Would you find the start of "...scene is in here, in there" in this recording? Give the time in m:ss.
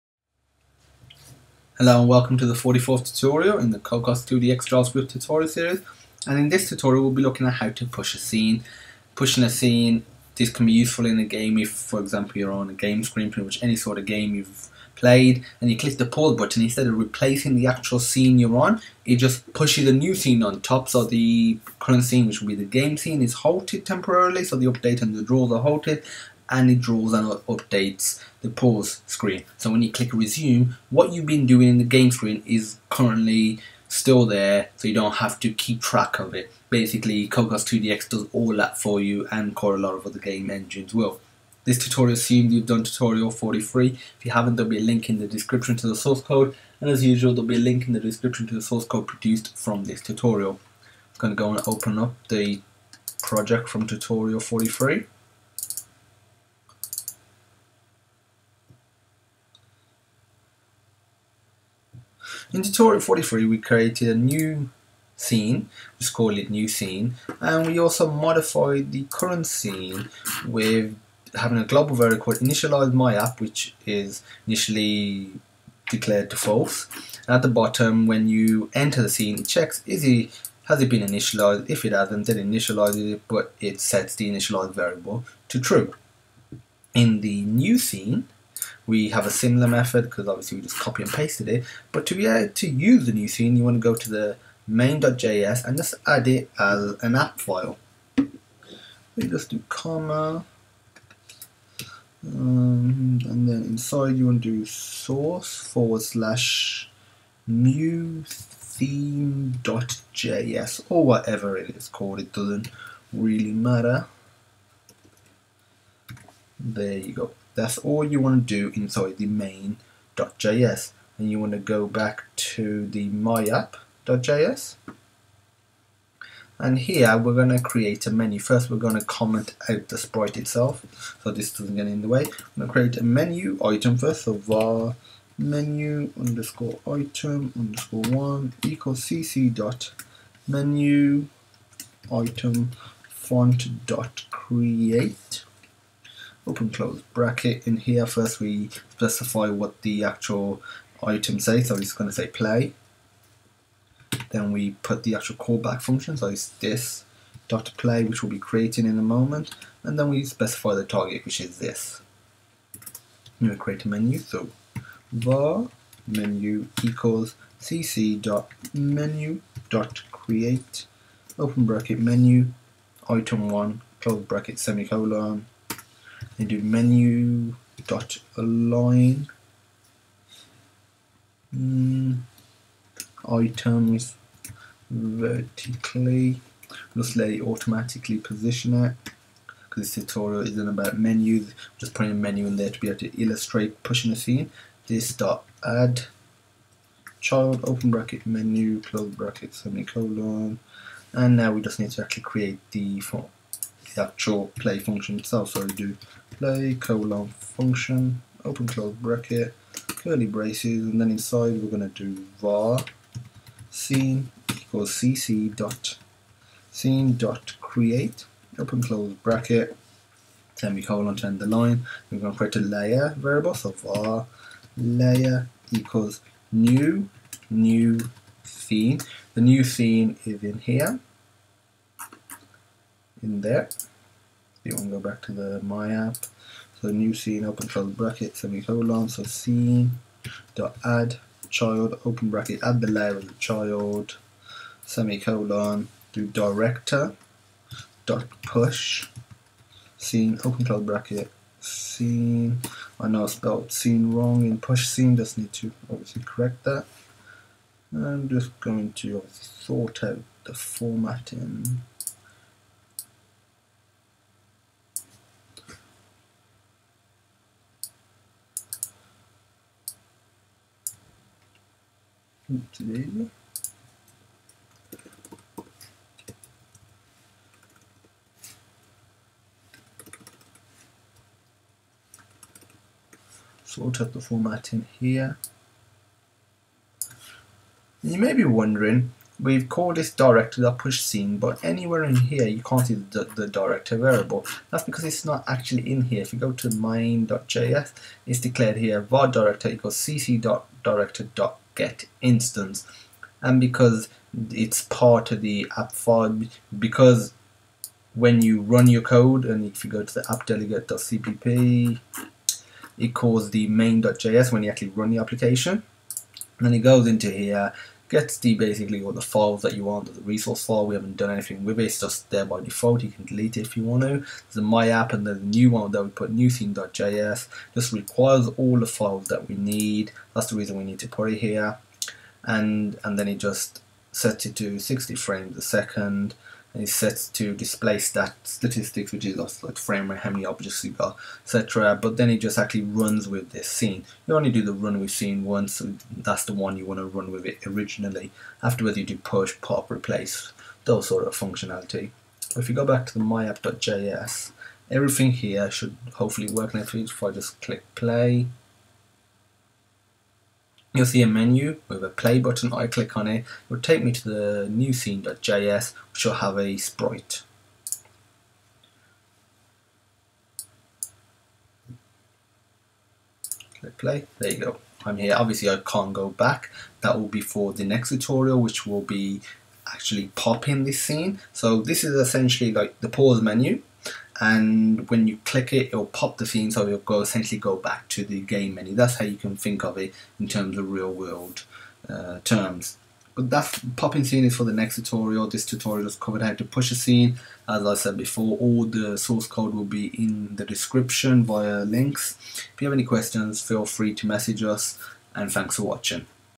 3:49.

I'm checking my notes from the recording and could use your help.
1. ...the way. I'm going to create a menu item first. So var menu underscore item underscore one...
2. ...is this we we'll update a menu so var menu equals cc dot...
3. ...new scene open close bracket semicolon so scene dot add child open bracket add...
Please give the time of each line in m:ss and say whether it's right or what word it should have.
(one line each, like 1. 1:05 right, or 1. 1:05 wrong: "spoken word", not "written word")
1. 2:12 right
2. 2:41 wrong: "create", not "update"
3. 3:56 right.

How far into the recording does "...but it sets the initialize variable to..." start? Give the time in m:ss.
1:23.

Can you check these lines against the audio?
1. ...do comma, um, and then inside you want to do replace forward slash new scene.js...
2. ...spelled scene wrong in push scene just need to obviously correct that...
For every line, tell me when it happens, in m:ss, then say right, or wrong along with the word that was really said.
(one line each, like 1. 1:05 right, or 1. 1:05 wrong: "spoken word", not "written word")
1. 1:39 wrong: "source", not "replace"
2. 4:13 right.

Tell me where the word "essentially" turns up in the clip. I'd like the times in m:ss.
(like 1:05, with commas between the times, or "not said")
6:22, 6:27.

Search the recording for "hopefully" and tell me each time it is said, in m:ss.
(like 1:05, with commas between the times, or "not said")
5:56.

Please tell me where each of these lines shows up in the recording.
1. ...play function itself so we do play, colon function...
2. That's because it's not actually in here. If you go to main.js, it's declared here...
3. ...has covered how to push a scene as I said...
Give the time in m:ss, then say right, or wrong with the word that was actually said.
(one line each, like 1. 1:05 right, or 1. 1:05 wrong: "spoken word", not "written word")
1. 3:24 right
2. 4:54 right
3. 6:36 right.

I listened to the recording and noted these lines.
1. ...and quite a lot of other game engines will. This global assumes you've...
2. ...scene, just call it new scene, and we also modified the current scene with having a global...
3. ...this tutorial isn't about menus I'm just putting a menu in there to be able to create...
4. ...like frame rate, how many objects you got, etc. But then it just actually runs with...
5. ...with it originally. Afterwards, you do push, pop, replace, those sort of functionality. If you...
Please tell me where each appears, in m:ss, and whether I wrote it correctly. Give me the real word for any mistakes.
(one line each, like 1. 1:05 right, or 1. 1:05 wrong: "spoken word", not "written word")
1. 0:39 wrong: "tutorial", not "global"
2. 1:05 right
3. 3:09 wrong: "illustrate", not "create"
4. 5:39 right
5. 5:47 right.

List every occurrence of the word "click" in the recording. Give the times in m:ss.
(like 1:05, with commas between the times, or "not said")
0:15, 0:29, 5:57, 6:02, 6:13, 6:25.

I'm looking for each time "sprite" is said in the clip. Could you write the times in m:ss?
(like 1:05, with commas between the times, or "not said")
2:09, 6:06.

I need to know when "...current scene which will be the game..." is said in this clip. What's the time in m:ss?
0:21.